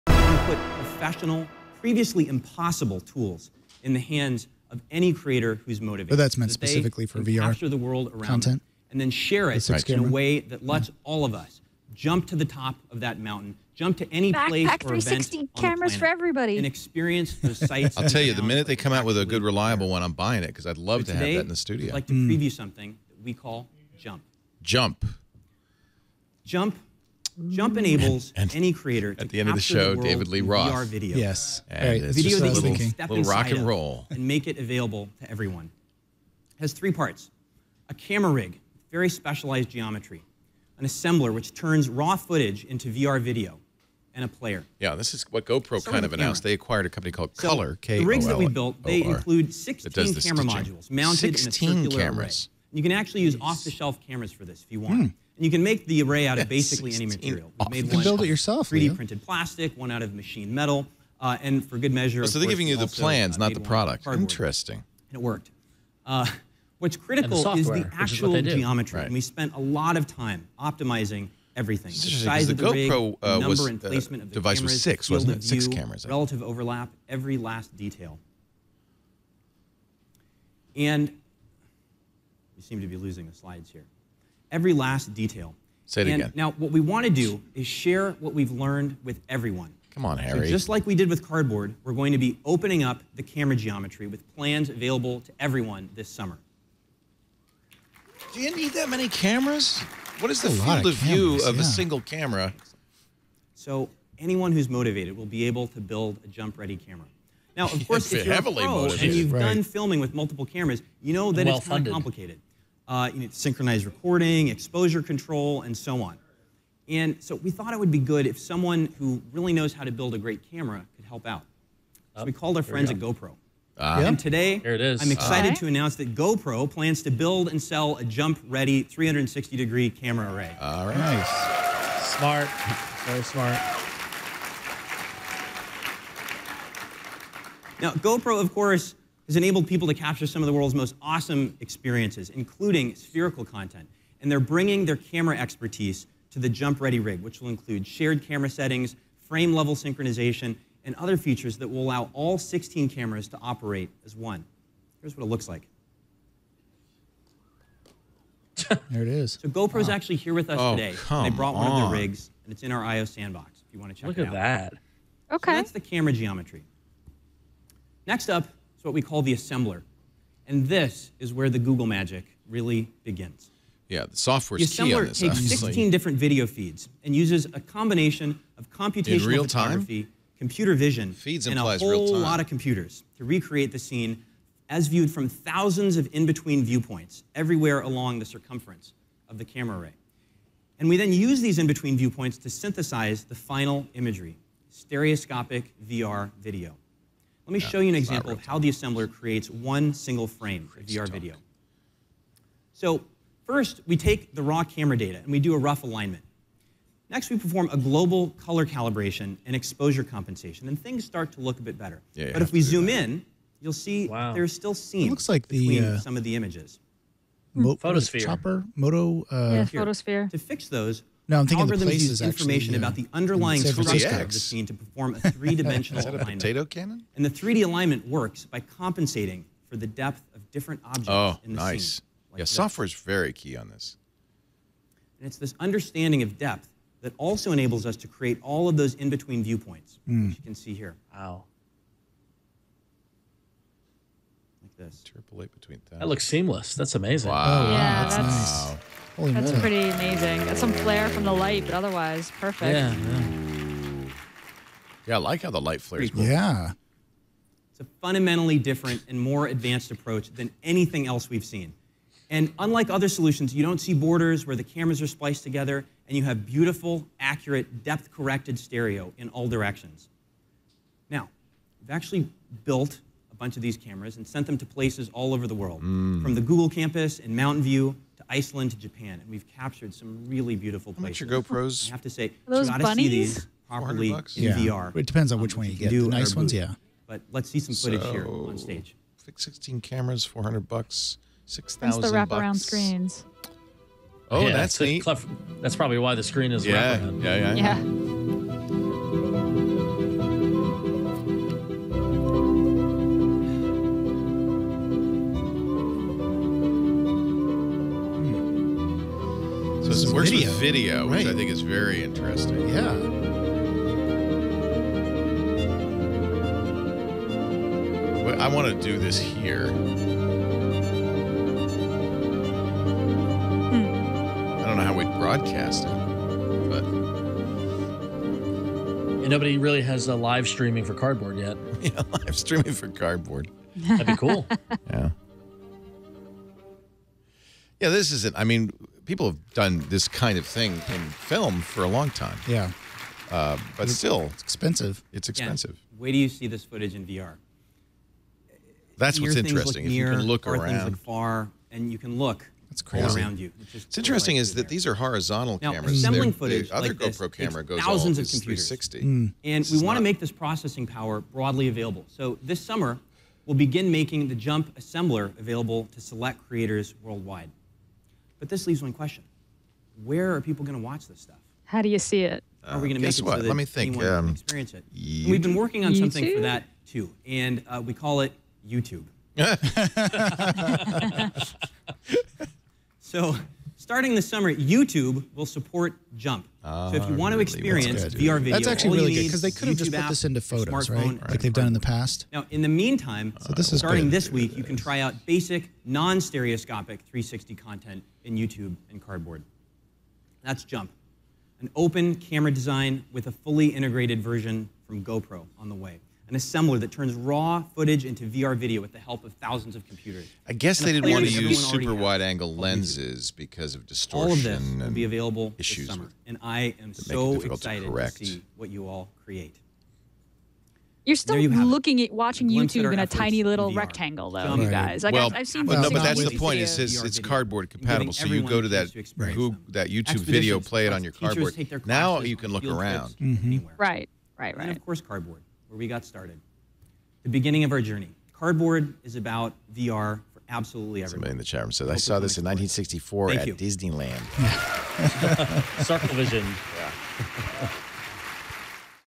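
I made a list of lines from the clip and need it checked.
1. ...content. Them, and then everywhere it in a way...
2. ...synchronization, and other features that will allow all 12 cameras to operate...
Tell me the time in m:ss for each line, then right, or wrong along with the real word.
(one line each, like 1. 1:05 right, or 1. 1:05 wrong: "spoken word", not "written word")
1. 0:08 wrong: "share", not "everywhere"
2. 2:29 wrong: "16", not "12".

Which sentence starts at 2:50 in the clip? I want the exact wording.
And this is where the Google magic really begins.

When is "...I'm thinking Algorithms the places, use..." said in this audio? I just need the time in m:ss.
3:41.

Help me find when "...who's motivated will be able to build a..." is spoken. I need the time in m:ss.
1:44.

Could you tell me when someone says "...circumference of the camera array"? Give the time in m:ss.
3:08.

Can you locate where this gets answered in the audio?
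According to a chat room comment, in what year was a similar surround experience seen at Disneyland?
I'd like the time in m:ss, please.
7:22.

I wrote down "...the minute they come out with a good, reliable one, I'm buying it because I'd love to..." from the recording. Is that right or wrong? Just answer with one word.
right.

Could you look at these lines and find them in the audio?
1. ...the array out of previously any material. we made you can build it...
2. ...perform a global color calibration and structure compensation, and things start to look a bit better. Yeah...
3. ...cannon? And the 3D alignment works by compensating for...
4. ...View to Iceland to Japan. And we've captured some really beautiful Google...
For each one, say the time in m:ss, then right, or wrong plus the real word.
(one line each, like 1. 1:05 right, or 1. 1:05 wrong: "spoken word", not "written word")
1. 0:55 wrong: "basically", not "previously"
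2. 3:27 wrong: "exposure", not "structure"
3. 3:46 right
4. 4:37 wrong: "How", not "Google".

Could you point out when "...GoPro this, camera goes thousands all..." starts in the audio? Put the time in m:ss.
5:56.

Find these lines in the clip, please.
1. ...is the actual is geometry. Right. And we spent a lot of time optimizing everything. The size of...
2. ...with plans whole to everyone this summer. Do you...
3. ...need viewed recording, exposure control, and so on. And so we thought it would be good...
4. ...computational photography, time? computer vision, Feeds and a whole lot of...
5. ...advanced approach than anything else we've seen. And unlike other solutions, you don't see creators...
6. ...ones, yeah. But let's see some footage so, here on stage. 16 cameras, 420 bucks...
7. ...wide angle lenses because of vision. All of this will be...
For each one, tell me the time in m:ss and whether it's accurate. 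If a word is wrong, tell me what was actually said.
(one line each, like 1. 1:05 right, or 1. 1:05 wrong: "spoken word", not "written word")
1. 1:07 right
2. 1:34 wrong: "available", not "whole"
3. 1:53 wrong: "synchronized", not "viewed"
4. 2:58 right
5. 4:19 wrong: "borders", not "creators"
6. 4:46 wrong: "400", not "420"
7. 6:51 wrong: "distortion", not "vision".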